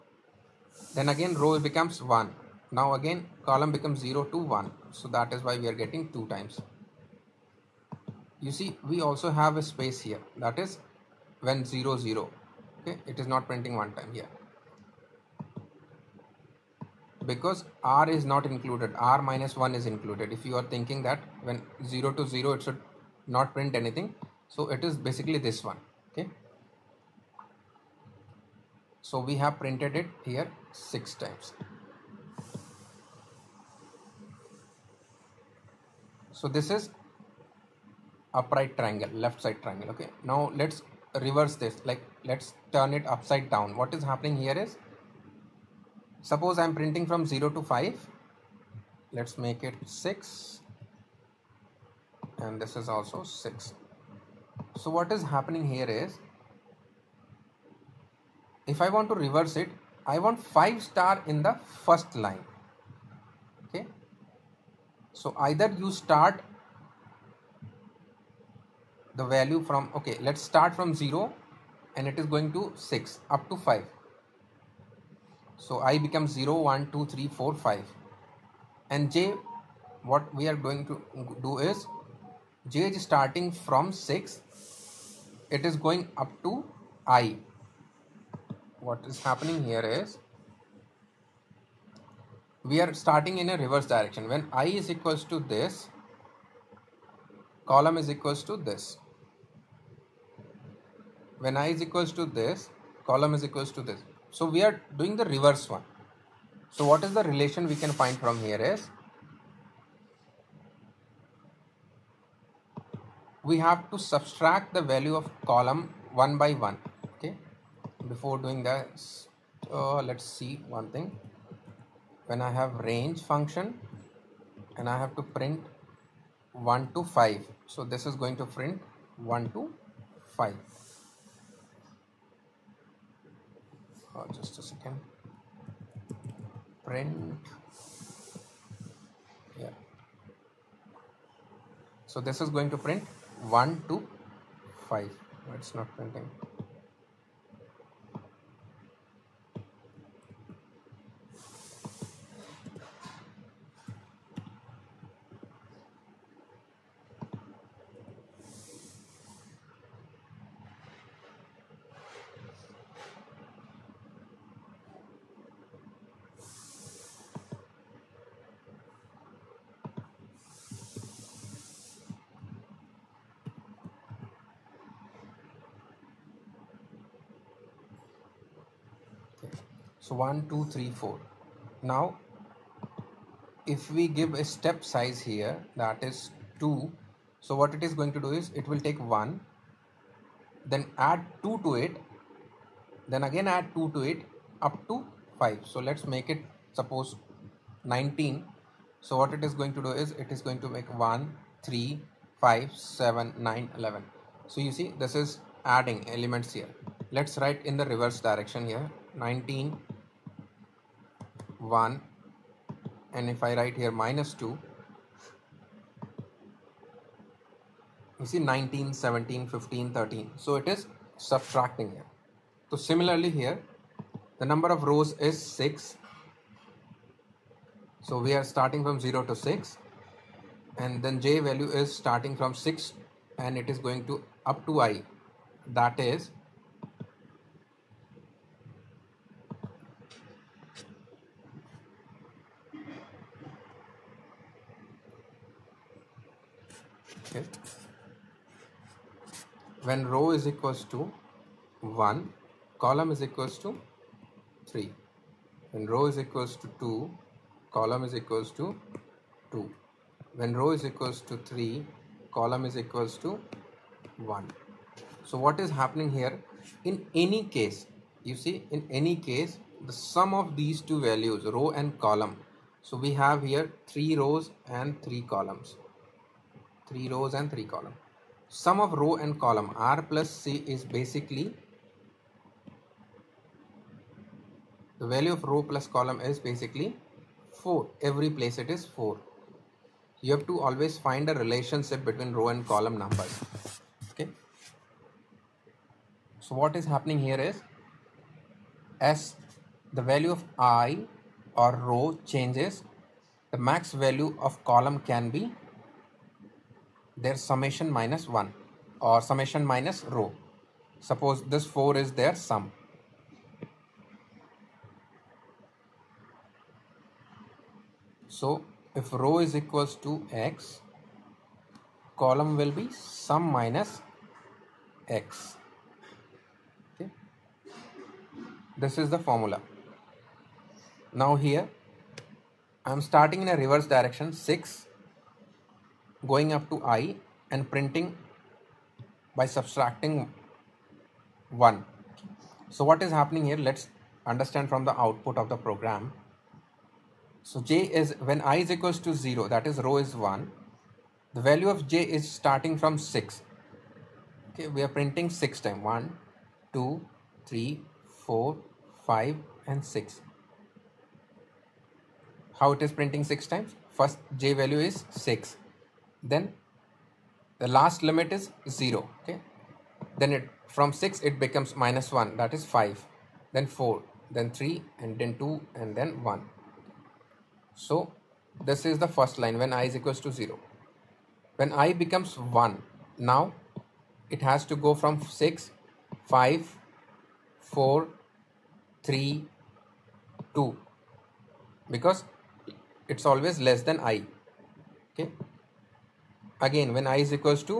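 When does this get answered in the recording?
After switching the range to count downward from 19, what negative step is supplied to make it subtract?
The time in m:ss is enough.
3:33.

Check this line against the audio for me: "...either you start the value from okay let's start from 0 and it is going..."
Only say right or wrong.
right.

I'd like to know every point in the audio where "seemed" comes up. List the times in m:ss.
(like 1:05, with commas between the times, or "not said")
not said.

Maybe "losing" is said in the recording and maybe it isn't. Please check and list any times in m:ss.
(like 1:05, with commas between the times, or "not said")
not said.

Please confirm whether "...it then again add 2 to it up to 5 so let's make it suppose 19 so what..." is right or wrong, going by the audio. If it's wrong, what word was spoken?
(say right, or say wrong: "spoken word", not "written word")
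right.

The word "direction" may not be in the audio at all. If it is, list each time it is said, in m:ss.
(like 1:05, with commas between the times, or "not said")
1:33, 3:28, 5:33.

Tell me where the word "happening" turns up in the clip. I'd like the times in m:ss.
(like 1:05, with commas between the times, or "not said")
0:44, 0:55, 1:29, 4:25, 4:56, 5:43.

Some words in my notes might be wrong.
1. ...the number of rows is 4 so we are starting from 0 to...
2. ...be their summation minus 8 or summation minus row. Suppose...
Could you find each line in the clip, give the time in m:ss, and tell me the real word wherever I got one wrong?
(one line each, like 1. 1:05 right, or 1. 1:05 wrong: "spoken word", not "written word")
1. 3:44 wrong: "6", not "4"
2. 5:05 wrong: "1", not "8".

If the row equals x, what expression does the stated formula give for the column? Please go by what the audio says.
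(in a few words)
sum minus x.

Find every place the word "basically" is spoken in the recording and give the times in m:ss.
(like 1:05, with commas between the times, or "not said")
0:25, 4:40, 4:46.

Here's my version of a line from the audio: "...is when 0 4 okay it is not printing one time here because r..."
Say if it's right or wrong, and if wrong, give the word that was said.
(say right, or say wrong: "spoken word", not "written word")
wrong: "0", not "4".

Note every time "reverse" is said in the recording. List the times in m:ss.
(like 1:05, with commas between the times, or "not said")
0:41, 0:59, 1:33, 1:45, 3:27, 5:33.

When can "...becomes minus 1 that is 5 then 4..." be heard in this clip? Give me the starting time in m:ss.
6:11.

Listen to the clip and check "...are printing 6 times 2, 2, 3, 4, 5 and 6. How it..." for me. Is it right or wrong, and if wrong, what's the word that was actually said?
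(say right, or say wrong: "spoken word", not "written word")
wrong: "1", not "2".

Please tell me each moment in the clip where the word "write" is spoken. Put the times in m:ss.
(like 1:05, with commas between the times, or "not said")
3:27, 3:33.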